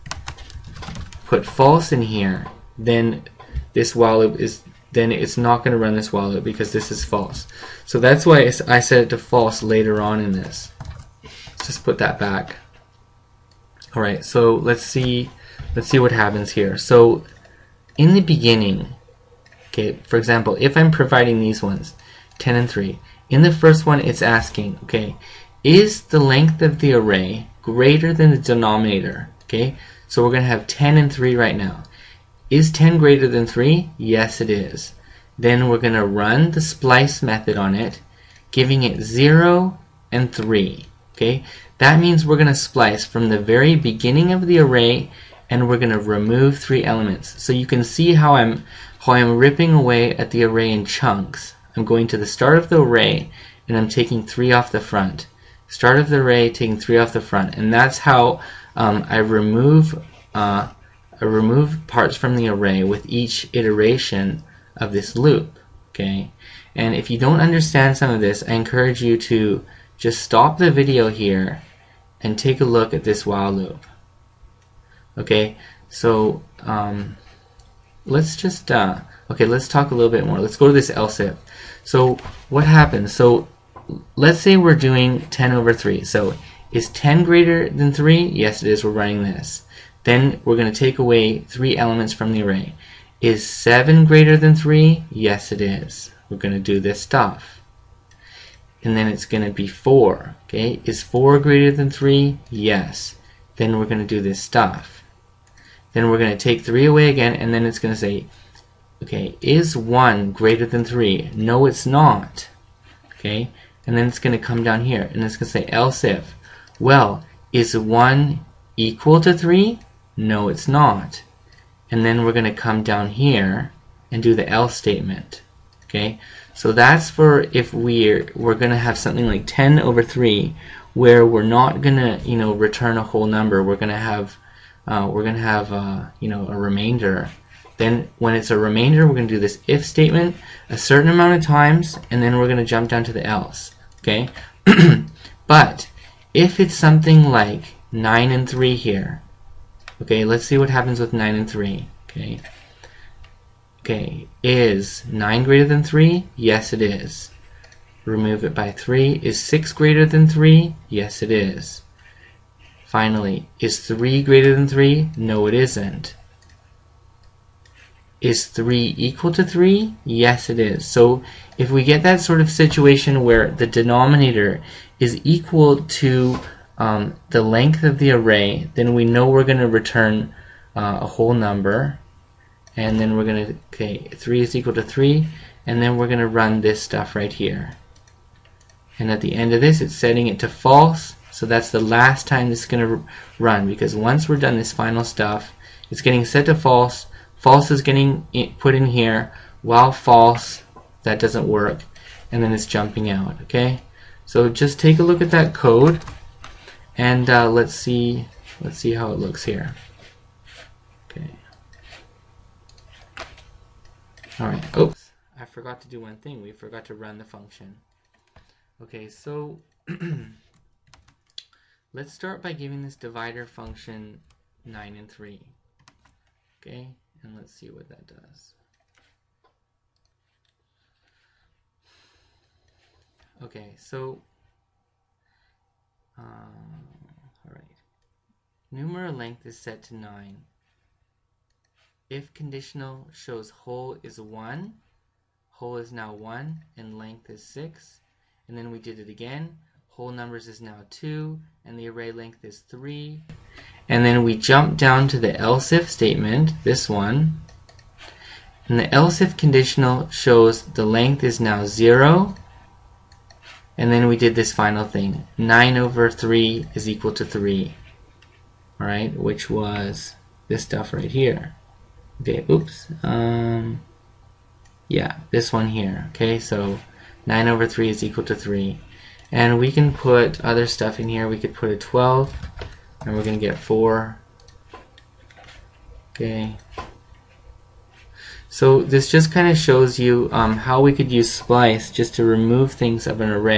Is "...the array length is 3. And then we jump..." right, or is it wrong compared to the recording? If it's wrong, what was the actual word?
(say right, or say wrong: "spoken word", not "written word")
right.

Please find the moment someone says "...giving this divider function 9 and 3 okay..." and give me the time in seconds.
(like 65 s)
222 s.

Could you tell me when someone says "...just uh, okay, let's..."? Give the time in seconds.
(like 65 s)
78 s.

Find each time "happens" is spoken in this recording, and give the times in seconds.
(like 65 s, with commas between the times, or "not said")
16 s, 82 s, 150 s.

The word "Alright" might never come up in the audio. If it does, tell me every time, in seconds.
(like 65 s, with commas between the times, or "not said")
13 s, 237 s, 268 s.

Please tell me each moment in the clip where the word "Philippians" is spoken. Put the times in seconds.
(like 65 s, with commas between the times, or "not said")
not said.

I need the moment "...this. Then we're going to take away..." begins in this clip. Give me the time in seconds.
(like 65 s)
89 s.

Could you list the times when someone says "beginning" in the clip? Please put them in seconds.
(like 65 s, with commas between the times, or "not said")
18 s, 43 s.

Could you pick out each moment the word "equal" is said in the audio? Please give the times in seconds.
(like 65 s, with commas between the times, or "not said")
118 s, 168 s, 175 s, 184 s, 266 s, 278 s.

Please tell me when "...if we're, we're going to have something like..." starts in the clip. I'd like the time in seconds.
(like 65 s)
127 s.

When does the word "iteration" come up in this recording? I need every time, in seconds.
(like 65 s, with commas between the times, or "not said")
63 s.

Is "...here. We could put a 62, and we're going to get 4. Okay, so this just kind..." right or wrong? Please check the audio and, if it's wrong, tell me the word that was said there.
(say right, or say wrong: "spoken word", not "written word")
wrong: "12", not "62".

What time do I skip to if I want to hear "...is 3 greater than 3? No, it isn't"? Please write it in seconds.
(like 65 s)
163 s.